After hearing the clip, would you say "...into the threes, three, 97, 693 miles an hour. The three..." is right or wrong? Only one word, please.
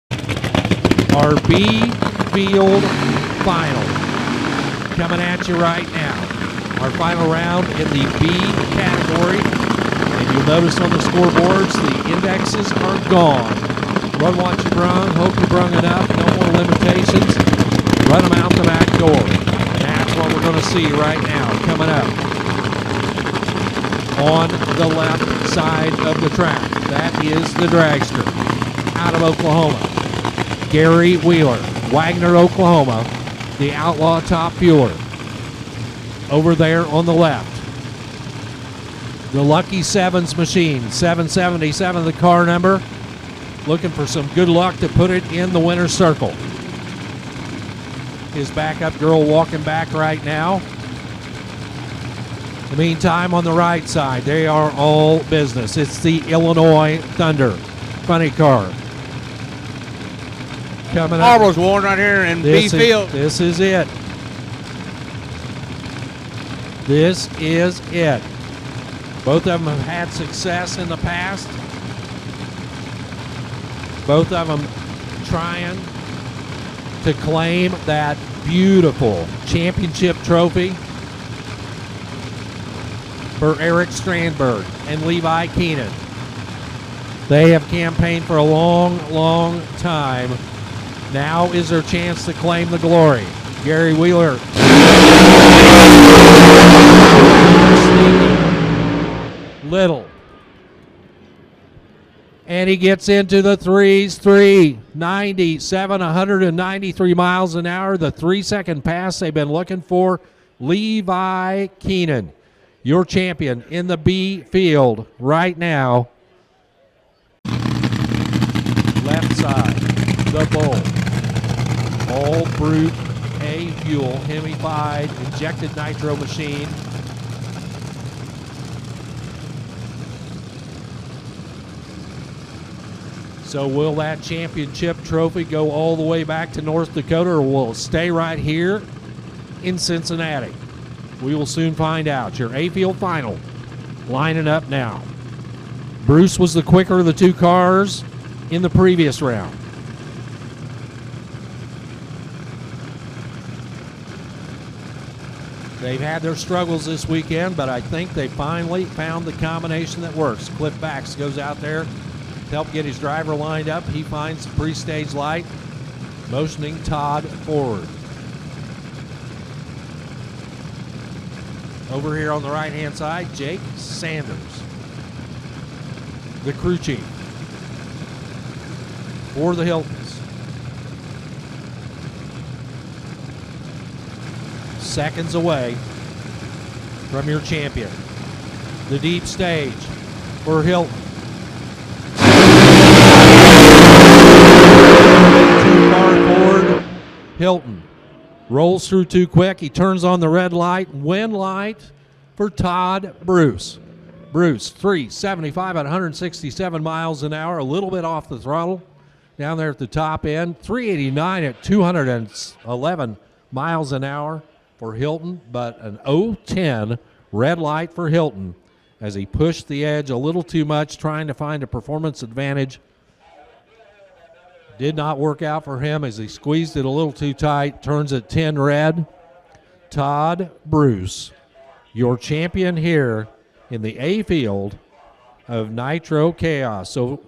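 wrong.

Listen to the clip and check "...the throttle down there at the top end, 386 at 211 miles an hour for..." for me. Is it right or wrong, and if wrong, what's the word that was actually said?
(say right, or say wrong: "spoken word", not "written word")
wrong: "389", not "386".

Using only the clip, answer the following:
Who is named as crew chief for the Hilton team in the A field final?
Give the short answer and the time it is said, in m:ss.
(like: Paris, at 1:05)
Jake Sanders, at 2:53.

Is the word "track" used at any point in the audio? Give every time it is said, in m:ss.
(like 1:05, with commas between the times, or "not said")
0:26.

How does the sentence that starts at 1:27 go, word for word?
They have campaigned for a long, long time now is their chance to claim the glory.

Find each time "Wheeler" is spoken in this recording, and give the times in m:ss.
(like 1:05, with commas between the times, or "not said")
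0:31, 1:33.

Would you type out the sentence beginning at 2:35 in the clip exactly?
They've had their struggles this weekend, but I think they finally found the combination that works.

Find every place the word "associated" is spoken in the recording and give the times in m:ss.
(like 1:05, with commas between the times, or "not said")
not said.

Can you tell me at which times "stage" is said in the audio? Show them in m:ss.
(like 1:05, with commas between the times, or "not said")
2:44, 3:09.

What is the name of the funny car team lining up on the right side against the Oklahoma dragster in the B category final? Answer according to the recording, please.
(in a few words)
Illinois Thunder.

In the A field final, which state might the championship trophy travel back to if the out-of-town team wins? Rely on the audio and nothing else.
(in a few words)
North Dakota.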